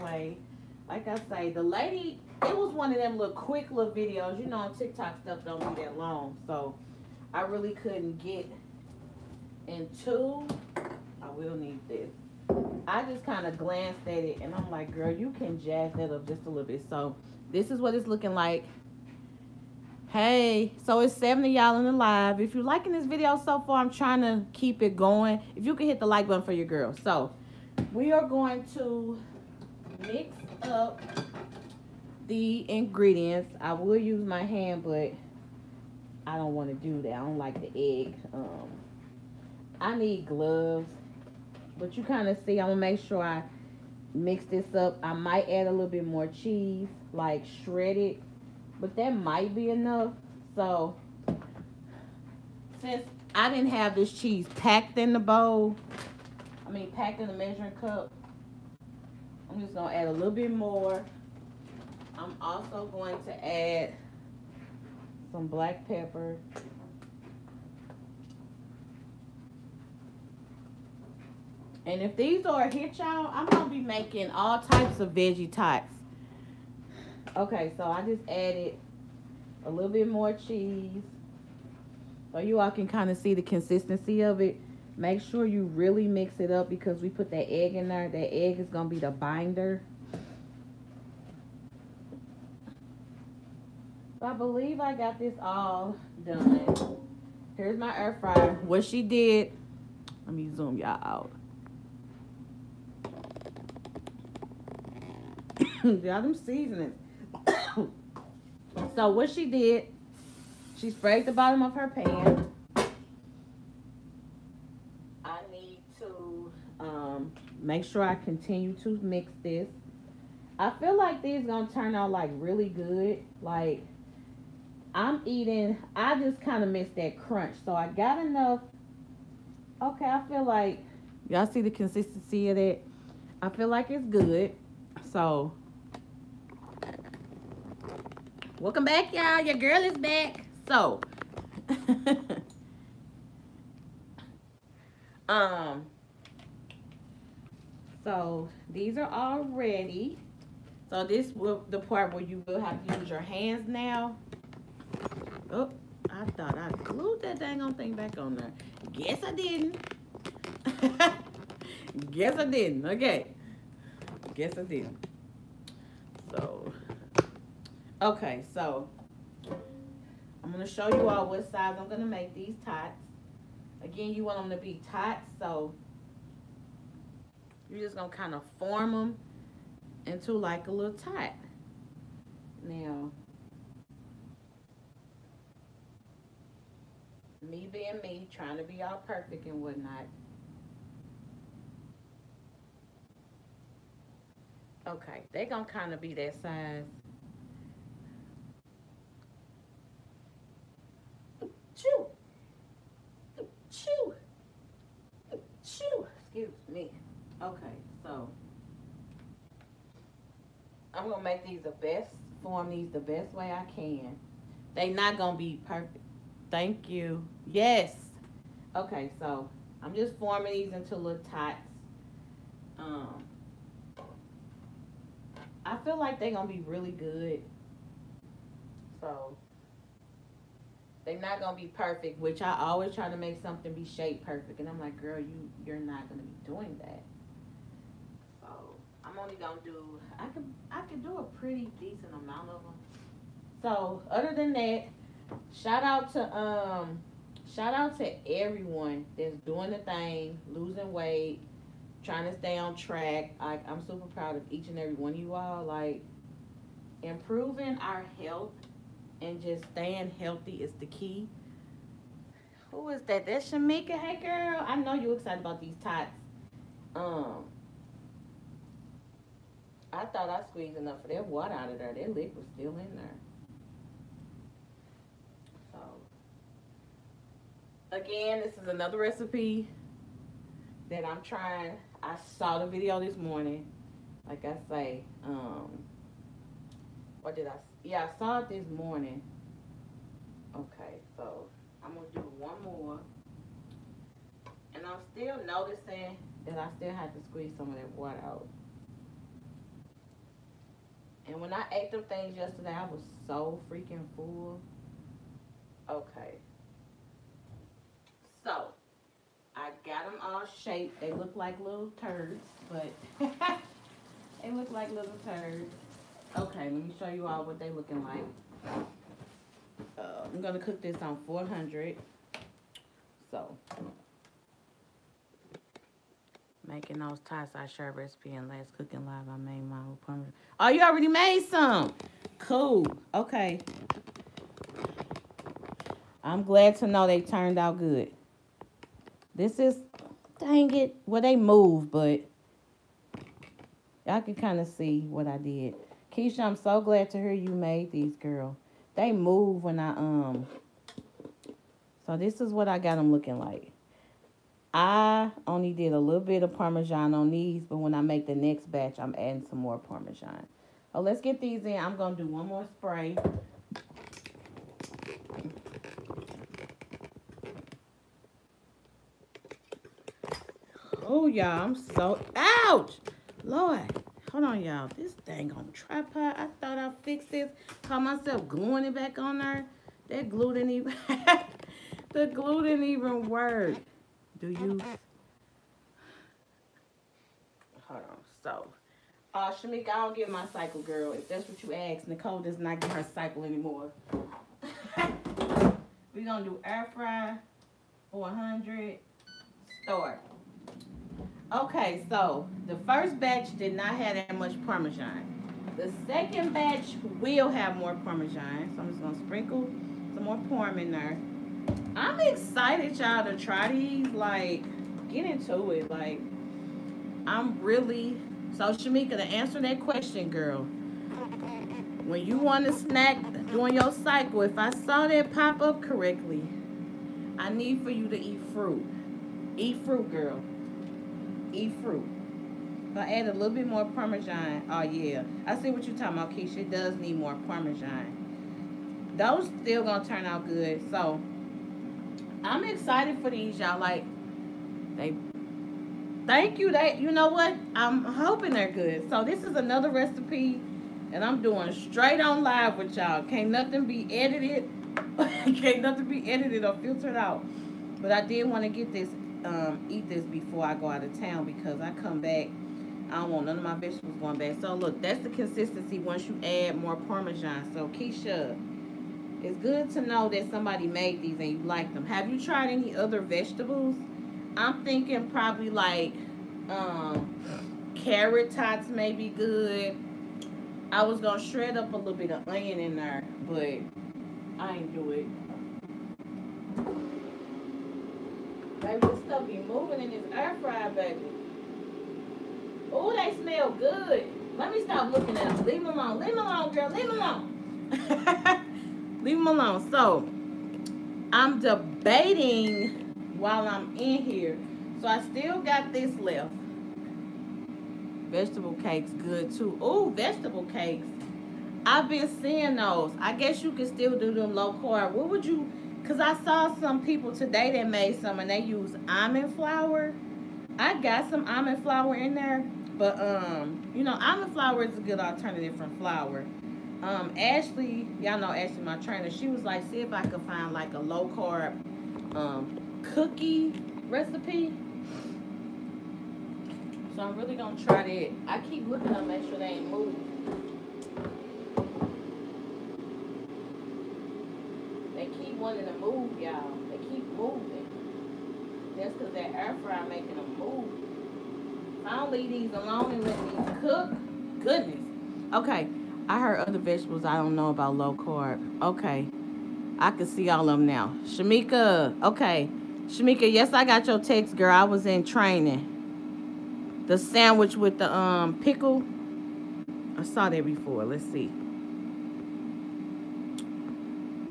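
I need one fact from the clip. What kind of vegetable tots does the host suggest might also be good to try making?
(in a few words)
carrot tots.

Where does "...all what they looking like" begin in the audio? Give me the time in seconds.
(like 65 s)
317 s.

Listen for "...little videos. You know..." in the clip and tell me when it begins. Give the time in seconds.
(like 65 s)
3 s.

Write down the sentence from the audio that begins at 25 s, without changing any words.
If you can hit the like button for your girl.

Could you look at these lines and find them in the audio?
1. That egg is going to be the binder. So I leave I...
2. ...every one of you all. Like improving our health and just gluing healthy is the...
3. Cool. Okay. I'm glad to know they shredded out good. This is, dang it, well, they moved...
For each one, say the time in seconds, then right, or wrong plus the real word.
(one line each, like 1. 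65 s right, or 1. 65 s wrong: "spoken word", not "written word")
1. 88 s wrong: "believe", not "leave"
2. 254 s wrong: "staying", not "gluing"
3. 332 s wrong: "turned", not "shredded".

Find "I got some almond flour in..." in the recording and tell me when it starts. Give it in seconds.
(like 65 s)
520 s.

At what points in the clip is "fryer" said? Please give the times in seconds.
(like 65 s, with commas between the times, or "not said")
98 s, 490 s, 549 s.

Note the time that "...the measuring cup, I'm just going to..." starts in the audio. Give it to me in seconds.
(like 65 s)
57 s.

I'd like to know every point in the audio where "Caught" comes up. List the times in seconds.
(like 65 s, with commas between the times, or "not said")
377 s.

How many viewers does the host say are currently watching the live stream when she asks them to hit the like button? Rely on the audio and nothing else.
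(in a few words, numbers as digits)
70.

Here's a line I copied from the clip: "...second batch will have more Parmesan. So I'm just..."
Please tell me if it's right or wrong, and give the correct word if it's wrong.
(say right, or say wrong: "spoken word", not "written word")
right.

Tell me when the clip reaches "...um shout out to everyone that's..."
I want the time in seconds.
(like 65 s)
246 s.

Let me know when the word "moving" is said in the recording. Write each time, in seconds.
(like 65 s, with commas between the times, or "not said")
489 s, 539 s, 547 s.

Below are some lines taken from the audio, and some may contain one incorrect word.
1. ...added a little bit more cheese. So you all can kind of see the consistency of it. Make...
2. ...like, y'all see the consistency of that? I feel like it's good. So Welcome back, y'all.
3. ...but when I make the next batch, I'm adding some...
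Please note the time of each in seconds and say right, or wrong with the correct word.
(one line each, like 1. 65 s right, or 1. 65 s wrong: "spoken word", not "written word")
1. 78 s right
2. 130 s right
3. 357 s right.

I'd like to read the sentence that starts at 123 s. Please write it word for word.
Like I'm eating, I just kind of missed that crunch.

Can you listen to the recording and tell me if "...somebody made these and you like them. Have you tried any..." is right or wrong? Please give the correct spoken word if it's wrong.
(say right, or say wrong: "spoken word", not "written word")
right.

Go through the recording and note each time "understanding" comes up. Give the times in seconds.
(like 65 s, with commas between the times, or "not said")
not said.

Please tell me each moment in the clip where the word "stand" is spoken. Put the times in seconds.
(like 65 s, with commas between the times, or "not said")
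not said.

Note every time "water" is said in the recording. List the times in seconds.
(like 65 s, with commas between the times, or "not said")
271 s, 297 s.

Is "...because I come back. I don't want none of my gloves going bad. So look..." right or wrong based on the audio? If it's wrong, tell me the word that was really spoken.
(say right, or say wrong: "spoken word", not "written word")
wrong: "vegetables", not "gloves".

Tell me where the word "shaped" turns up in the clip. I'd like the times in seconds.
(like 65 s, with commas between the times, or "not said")
233 s, 310 s.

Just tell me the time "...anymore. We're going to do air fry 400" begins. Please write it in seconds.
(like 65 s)
393 s.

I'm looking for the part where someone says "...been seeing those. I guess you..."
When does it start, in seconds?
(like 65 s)
512 s.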